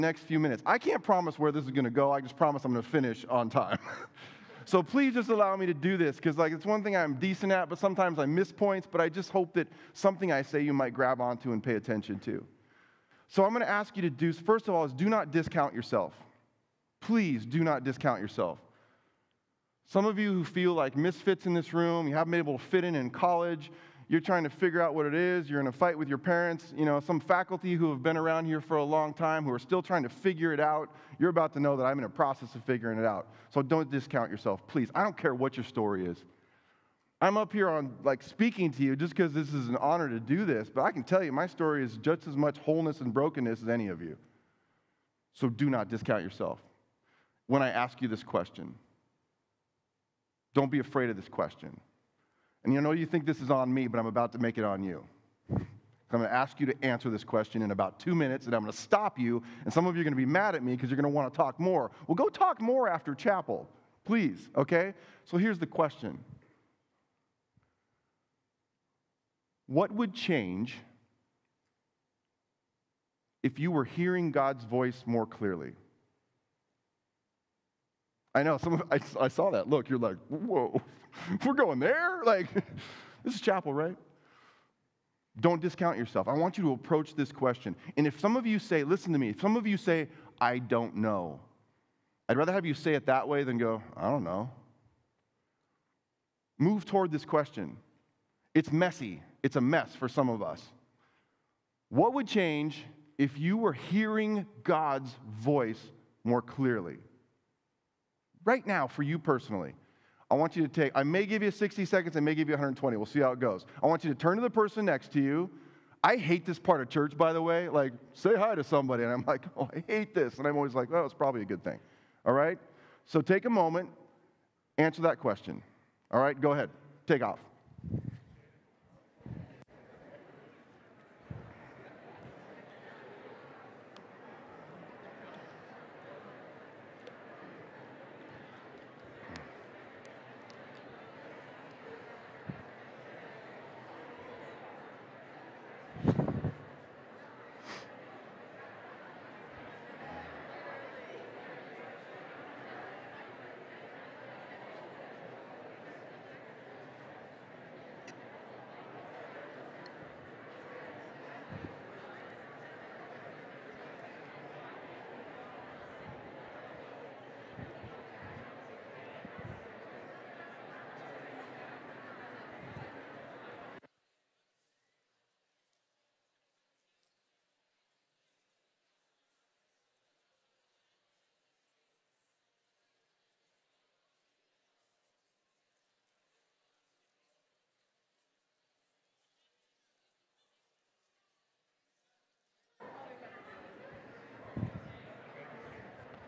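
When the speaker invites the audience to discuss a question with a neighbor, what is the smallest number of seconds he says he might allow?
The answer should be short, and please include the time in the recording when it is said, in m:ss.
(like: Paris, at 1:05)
60 seconds, at 1:51.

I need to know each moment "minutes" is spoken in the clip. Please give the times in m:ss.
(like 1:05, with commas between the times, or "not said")
0:00, 0:58.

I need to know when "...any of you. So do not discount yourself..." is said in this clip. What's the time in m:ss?
0:43.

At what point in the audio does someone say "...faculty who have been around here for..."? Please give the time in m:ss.
0:27.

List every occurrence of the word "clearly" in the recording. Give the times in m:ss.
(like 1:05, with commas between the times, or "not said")
1:15, 1:46.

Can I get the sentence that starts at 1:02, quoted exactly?
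Well, go talk more after chapel, please, okay?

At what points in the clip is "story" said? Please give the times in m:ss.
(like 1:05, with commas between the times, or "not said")
0:35, 0:41.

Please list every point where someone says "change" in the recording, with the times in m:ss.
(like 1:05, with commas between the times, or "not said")
1:10, 1:42.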